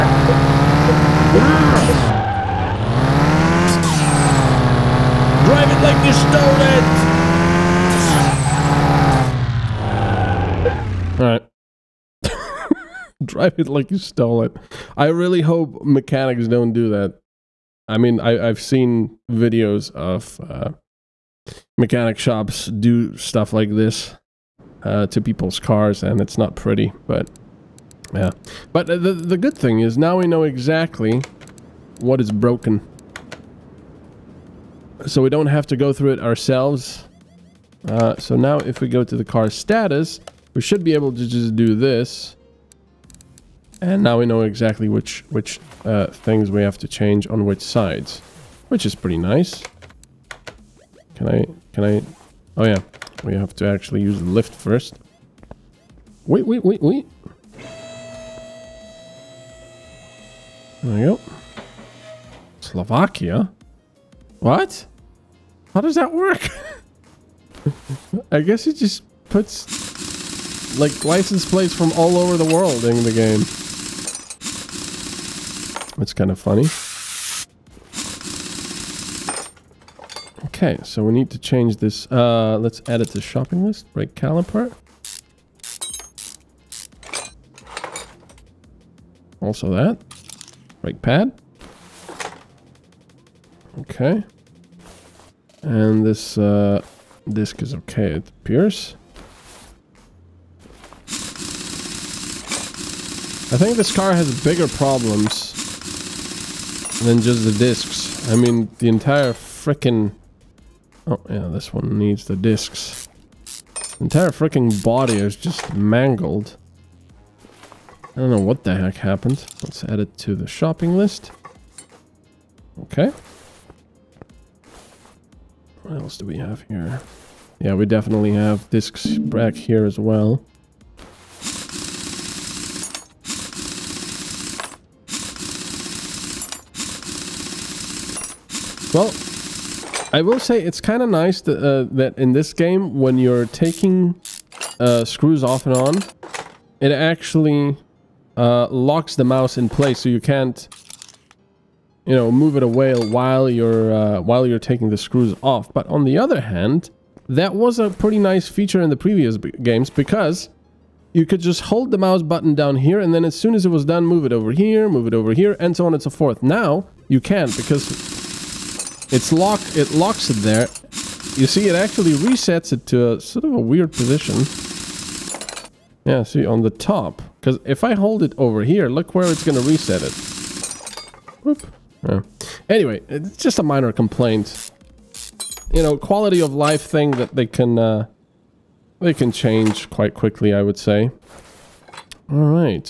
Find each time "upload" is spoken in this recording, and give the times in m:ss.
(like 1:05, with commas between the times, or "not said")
not said.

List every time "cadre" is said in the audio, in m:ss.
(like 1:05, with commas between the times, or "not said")
not said.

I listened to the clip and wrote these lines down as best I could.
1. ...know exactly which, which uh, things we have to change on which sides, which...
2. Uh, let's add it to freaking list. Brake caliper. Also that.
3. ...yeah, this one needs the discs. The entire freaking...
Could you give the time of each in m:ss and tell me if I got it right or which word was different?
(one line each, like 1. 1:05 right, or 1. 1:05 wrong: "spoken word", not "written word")
1. 0:44 right
2. 1:22 wrong: "shopping", not "freaking"
3. 1:51 right.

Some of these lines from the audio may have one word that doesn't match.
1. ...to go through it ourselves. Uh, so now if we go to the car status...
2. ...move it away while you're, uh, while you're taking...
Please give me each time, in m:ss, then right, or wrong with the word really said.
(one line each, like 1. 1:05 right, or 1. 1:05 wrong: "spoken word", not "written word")
1. 0:35 right
2. 2:32 right.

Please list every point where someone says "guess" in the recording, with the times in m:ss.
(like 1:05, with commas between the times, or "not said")
1:08.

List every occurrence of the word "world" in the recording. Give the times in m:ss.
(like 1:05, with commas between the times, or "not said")
1:12.